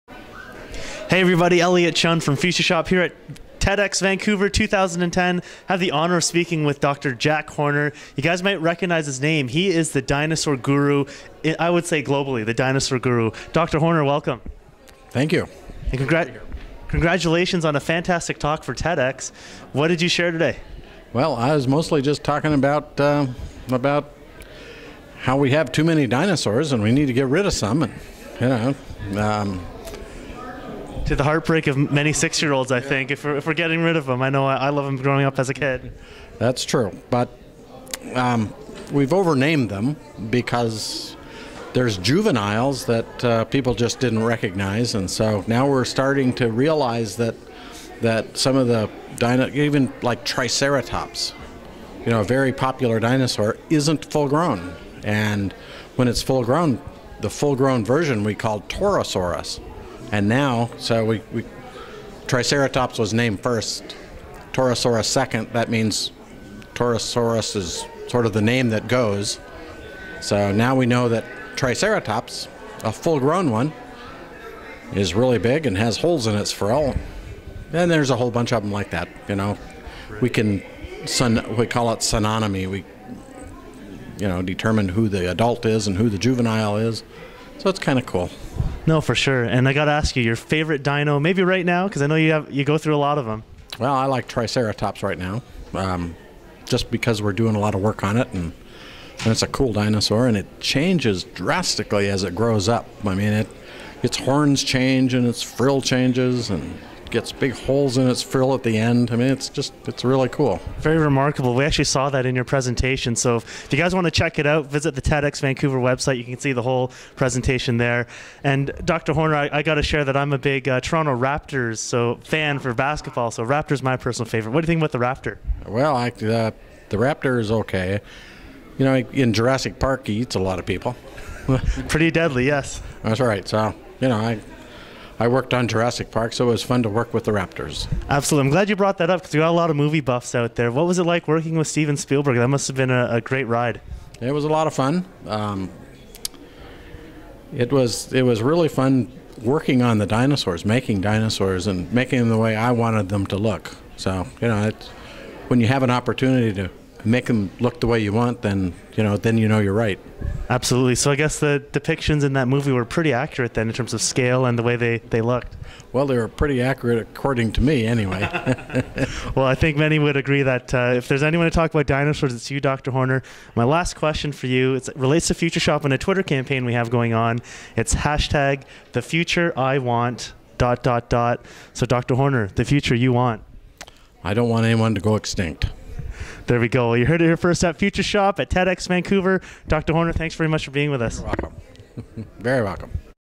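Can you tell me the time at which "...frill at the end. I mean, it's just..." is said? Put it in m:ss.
1:48.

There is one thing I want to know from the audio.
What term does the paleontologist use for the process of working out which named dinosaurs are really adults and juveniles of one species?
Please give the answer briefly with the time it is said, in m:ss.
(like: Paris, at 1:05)
synonymy, at 1:21.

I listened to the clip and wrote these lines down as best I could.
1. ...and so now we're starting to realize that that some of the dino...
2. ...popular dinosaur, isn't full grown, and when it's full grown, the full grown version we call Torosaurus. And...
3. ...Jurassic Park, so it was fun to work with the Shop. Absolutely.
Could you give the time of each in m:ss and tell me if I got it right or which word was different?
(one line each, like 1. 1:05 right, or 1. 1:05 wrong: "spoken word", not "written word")
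1. 0:44 right
2. 0:52 right
3. 2:15 wrong: "Raptors", not "Shop".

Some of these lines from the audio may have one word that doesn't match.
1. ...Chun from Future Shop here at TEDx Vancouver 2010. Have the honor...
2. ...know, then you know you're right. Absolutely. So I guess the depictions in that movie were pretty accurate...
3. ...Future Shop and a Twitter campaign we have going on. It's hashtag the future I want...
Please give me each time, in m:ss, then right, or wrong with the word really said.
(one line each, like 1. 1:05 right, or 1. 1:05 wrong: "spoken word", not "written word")
1. 0:01 right
2. 2:39 right
3. 2:55 right.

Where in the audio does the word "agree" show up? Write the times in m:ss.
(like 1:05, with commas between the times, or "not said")
2:50.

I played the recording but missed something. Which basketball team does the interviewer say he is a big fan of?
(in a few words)
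Toronto Raptors.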